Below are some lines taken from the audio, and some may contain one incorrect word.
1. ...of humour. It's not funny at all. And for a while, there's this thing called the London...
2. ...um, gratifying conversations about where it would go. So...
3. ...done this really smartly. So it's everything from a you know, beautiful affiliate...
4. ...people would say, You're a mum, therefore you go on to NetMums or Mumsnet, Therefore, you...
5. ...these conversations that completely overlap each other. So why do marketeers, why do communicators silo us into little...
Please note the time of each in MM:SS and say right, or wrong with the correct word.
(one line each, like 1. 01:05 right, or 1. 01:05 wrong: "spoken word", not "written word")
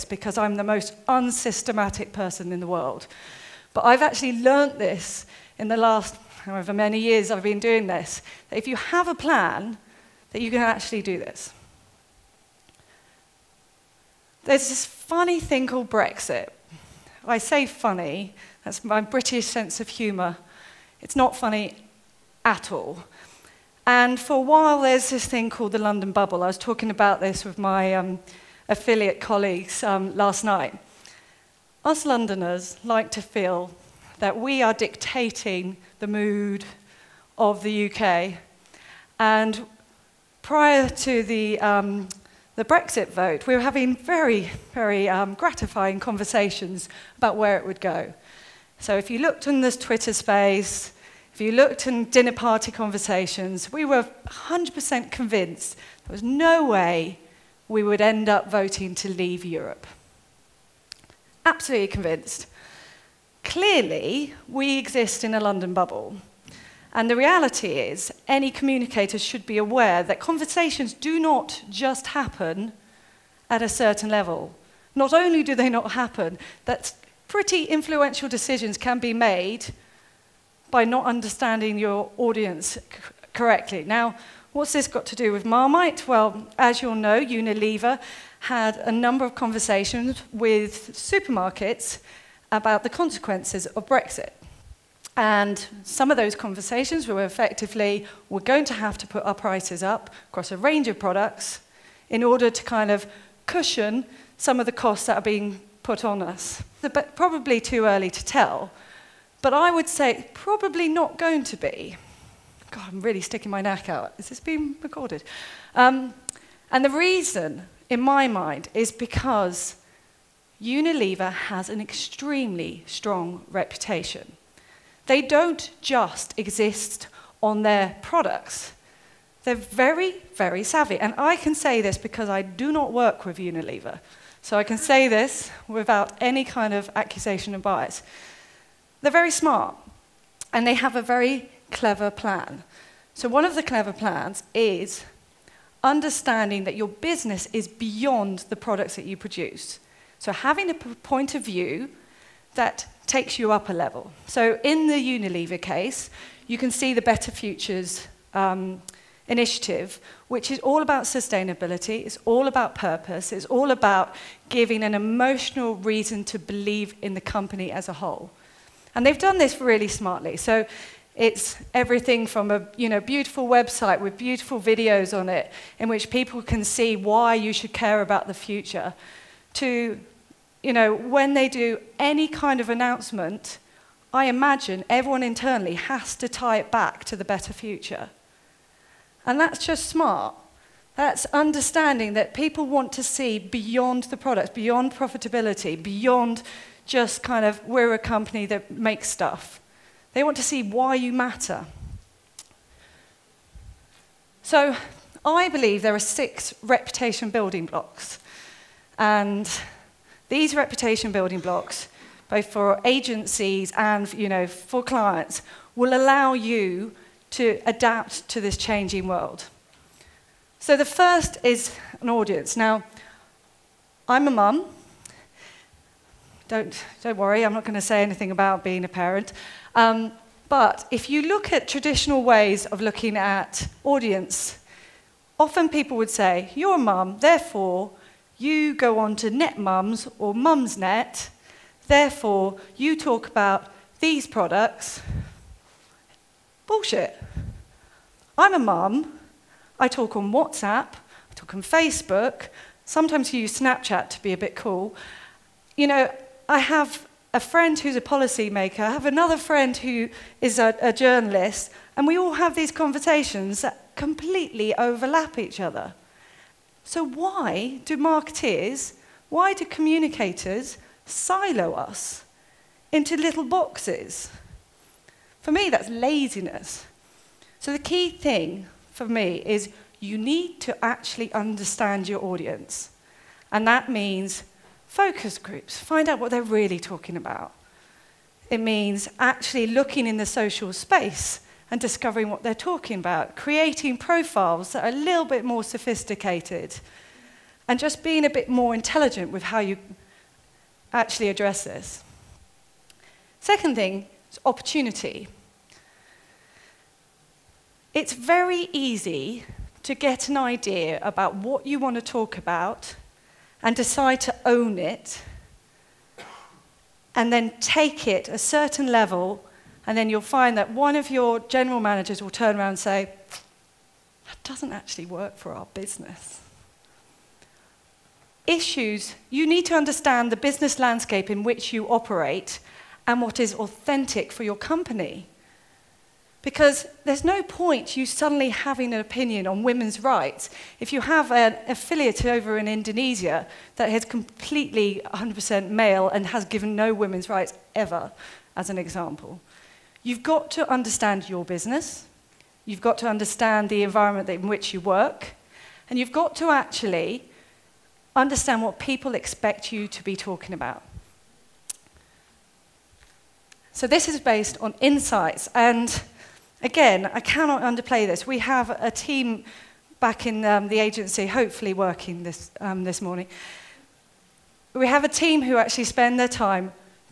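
1. 00:19 right
2. 00:45 right
3. 02:49 wrong: "website", not "affiliate"
4. 03:55 right
5. 04:22 right.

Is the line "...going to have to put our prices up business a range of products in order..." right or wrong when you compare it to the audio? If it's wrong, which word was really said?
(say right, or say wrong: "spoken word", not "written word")
wrong: "across", not "business".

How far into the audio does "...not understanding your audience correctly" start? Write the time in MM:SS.
01:20.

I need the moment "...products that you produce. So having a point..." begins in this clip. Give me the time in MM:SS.
02:28.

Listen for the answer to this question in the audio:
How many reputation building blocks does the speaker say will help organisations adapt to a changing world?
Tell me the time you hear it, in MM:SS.
03:25.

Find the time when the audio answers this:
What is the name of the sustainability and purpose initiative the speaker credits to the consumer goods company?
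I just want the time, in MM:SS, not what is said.
02:36.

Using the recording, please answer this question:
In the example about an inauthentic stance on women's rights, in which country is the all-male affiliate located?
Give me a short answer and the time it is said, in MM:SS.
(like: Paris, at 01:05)
Indonesia, at 05:42.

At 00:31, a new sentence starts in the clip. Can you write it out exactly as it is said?
Us Londoners like to feel that we are dictating the mood of the UK.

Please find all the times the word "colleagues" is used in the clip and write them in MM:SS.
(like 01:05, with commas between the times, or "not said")
00:29.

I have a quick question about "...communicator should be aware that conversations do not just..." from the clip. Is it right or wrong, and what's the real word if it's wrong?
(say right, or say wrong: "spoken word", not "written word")
right.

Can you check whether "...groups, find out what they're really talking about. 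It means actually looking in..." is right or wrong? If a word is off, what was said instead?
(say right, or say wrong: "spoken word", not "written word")
right.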